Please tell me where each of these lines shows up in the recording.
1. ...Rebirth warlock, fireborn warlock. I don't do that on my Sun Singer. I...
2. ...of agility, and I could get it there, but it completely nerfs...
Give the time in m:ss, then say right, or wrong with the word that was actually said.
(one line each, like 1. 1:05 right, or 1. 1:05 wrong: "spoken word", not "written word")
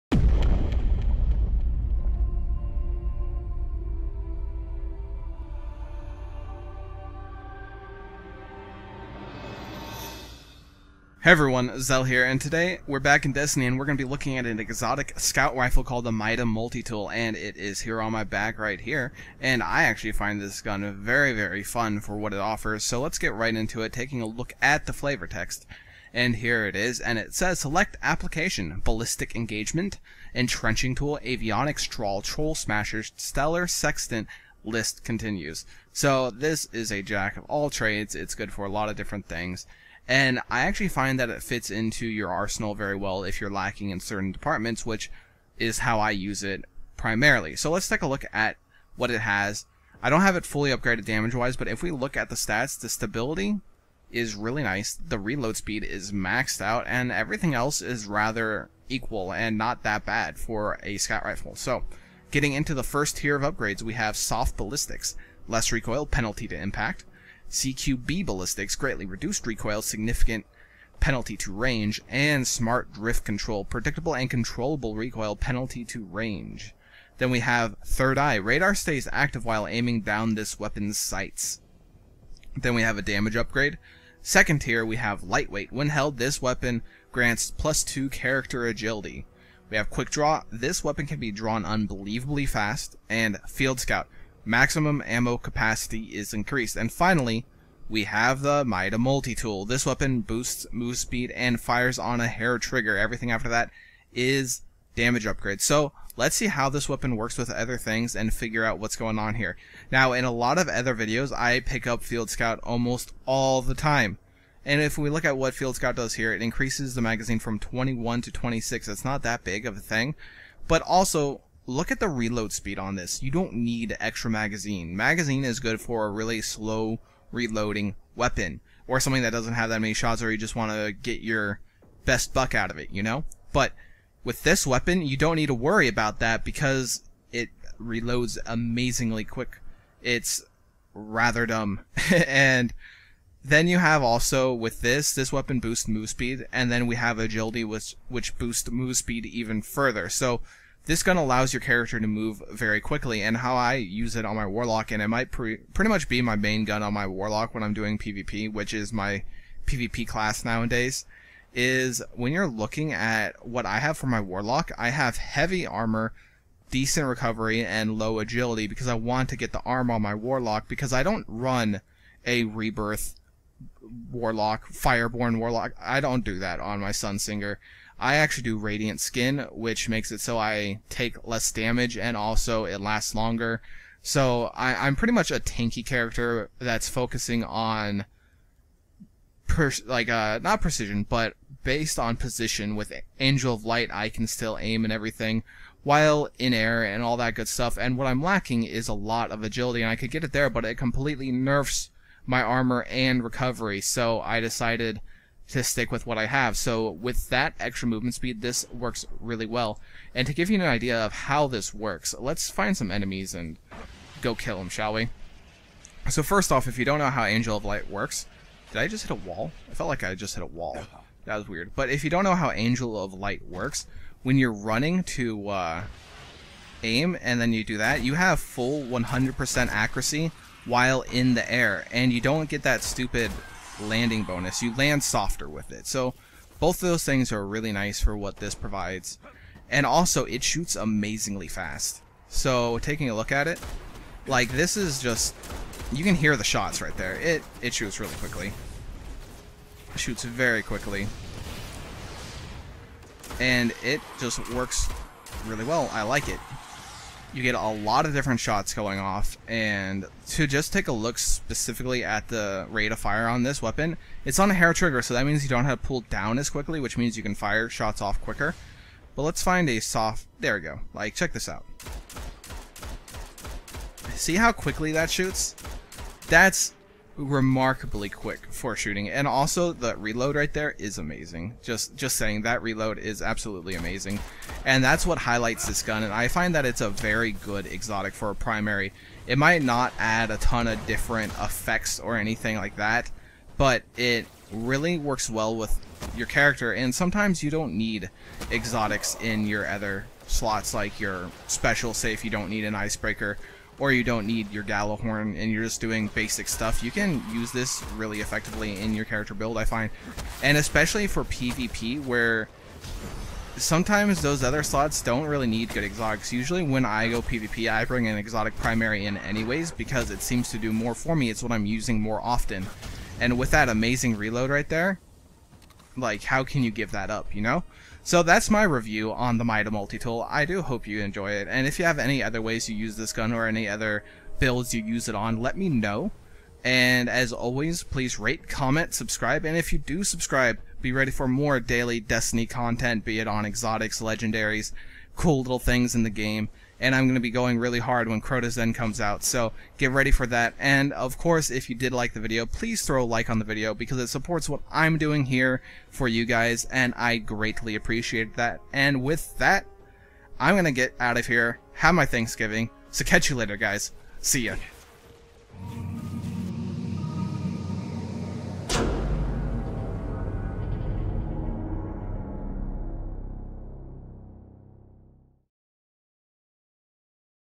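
1. 2:52 right
2. 3:19 right.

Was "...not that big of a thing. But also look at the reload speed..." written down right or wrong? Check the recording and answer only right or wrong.
right.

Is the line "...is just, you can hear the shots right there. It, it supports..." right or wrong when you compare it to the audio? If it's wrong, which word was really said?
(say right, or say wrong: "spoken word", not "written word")
wrong: "shoots", not "supports".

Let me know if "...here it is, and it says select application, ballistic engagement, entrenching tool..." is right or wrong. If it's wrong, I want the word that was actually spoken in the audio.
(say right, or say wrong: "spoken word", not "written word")
right.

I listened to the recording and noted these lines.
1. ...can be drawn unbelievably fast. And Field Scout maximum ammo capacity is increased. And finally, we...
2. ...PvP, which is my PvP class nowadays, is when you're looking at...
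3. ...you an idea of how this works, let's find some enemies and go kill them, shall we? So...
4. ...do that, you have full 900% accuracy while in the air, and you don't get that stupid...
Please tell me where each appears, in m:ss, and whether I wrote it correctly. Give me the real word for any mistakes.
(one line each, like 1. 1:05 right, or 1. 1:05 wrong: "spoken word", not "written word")
1. 1:31 right
2. 2:37 right
3. 3:30 right
4. 3:47 wrong: "100", not "900".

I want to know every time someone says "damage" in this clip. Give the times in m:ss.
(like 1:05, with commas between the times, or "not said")
0:51, 1:23, 1:44, 3:01.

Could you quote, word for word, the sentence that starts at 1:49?
Now in a lot of other videos I pick up Field Scout almost all the time.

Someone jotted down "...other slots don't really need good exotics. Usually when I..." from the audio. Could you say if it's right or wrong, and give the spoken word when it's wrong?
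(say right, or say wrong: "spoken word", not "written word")
right.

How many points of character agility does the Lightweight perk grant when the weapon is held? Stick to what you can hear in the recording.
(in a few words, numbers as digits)
2.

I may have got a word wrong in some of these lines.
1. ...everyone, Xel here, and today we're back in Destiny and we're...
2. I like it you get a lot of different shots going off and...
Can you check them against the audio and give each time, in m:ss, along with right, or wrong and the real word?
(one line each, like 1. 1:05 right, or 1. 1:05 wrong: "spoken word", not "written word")
1. 0:11 right
2. 4:15 right.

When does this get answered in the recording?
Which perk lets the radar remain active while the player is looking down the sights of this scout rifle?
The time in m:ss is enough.
1:17.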